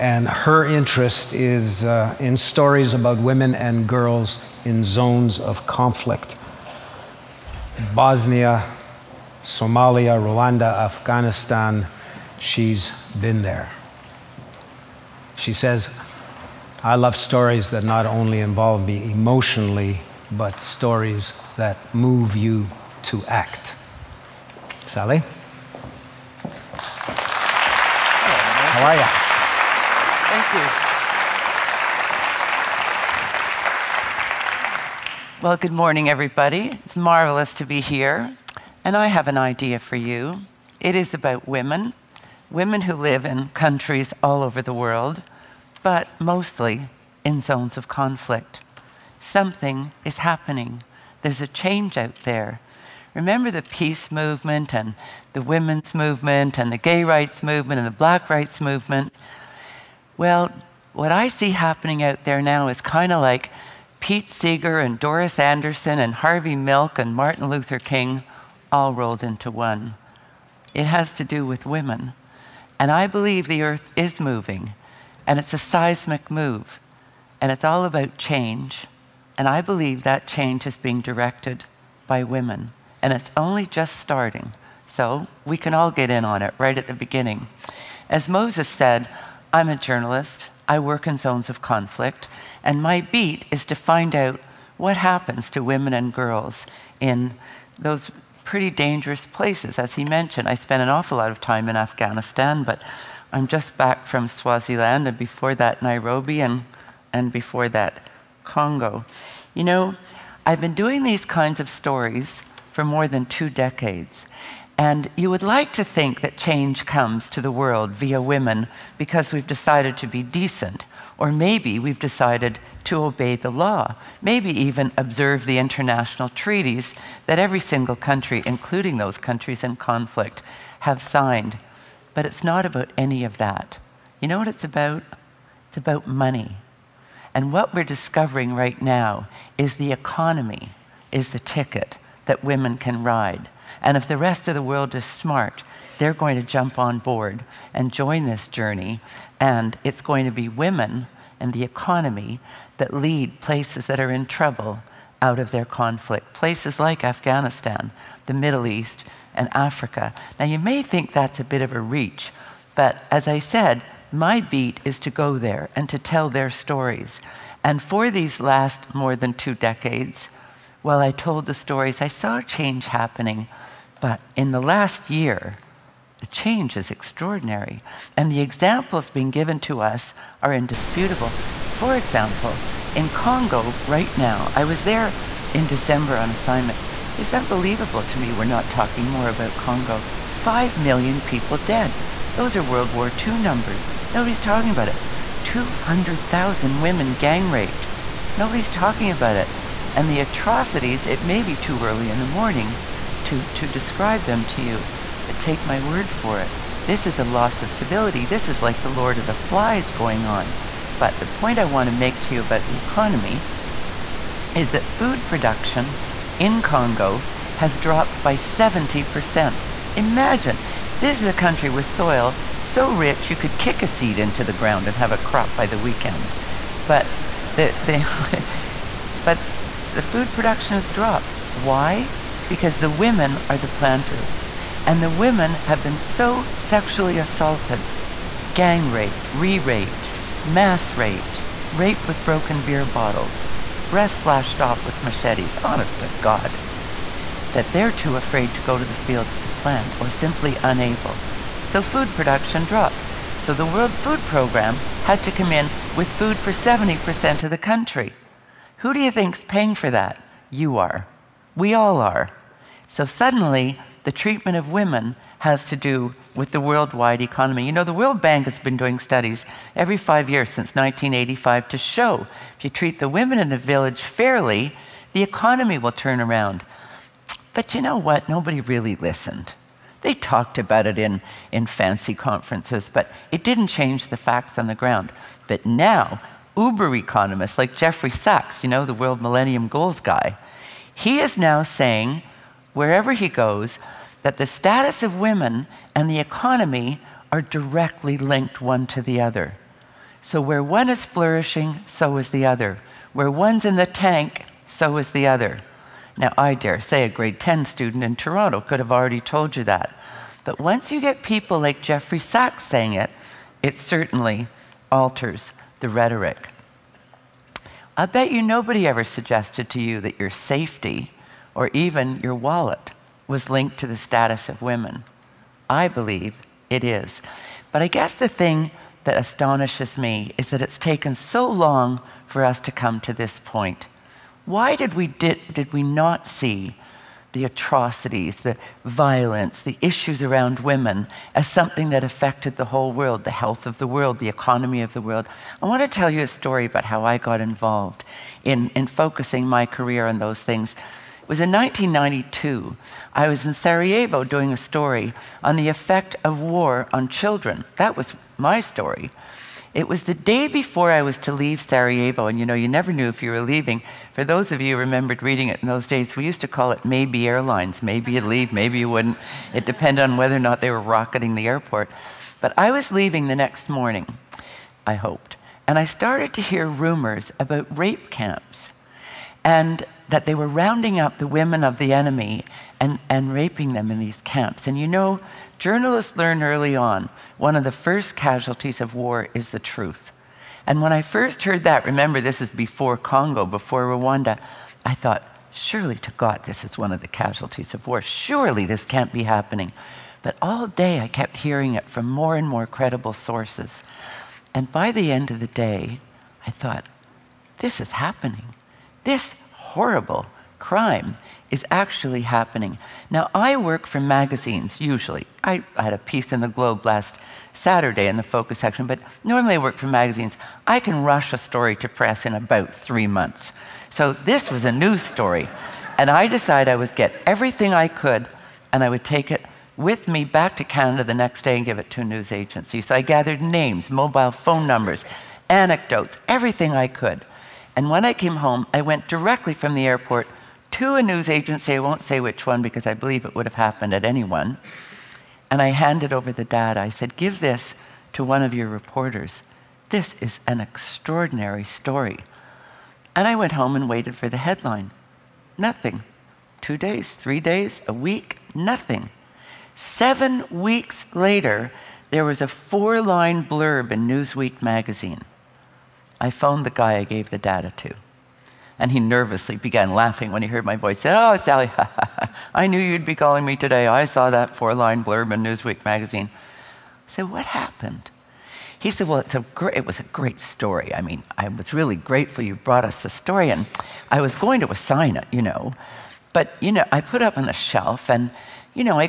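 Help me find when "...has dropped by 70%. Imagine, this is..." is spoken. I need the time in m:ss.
3:37.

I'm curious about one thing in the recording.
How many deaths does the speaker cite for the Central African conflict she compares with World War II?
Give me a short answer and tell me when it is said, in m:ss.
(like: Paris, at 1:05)
5 million, at 3:10.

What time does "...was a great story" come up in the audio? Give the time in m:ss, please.
7:59.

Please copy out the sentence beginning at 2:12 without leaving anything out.
But it's not about any of that.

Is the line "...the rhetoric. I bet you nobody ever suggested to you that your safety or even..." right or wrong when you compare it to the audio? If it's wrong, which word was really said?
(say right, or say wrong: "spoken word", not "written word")
right.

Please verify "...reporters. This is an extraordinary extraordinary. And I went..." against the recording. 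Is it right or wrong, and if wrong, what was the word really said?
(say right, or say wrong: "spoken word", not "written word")
wrong: "story", not "extraordinary".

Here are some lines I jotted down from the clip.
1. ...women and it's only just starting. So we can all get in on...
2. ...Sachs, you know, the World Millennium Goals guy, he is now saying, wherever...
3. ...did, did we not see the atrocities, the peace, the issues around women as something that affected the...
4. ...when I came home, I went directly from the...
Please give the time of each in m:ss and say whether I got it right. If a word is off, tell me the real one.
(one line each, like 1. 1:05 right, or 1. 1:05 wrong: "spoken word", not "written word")
1. 1:22 right
2. 4:48 right
3. 5:35 wrong: "violence", not "peace"
4. 7:17 right.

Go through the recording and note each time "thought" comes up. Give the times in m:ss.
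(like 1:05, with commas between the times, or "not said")
6:34, 6:46.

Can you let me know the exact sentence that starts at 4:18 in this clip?
Who do you think's paying for that?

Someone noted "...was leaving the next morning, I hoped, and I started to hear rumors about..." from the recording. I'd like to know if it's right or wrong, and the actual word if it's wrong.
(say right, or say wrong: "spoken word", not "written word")
right.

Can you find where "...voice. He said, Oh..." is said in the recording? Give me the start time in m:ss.
7:50.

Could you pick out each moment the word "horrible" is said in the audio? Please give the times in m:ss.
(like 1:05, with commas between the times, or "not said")
6:49.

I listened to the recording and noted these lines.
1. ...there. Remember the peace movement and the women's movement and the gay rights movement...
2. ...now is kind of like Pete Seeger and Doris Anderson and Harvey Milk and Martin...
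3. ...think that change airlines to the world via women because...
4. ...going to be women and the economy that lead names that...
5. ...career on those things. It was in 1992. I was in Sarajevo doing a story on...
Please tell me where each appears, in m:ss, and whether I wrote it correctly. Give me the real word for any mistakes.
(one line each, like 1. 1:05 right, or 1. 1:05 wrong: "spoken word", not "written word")
1. 0:52 right
2. 1:02 right
3. 1:55 wrong: "comes", not "airlines"
4. 2:30 wrong: "places", not "names"
5. 5:49 right.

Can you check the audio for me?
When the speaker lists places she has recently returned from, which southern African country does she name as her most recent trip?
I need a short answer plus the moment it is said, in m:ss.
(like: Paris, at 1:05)
Swaziland, at 1:44.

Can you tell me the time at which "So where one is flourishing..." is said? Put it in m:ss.
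5:00.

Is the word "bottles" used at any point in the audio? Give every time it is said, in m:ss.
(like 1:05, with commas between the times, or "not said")
4:02.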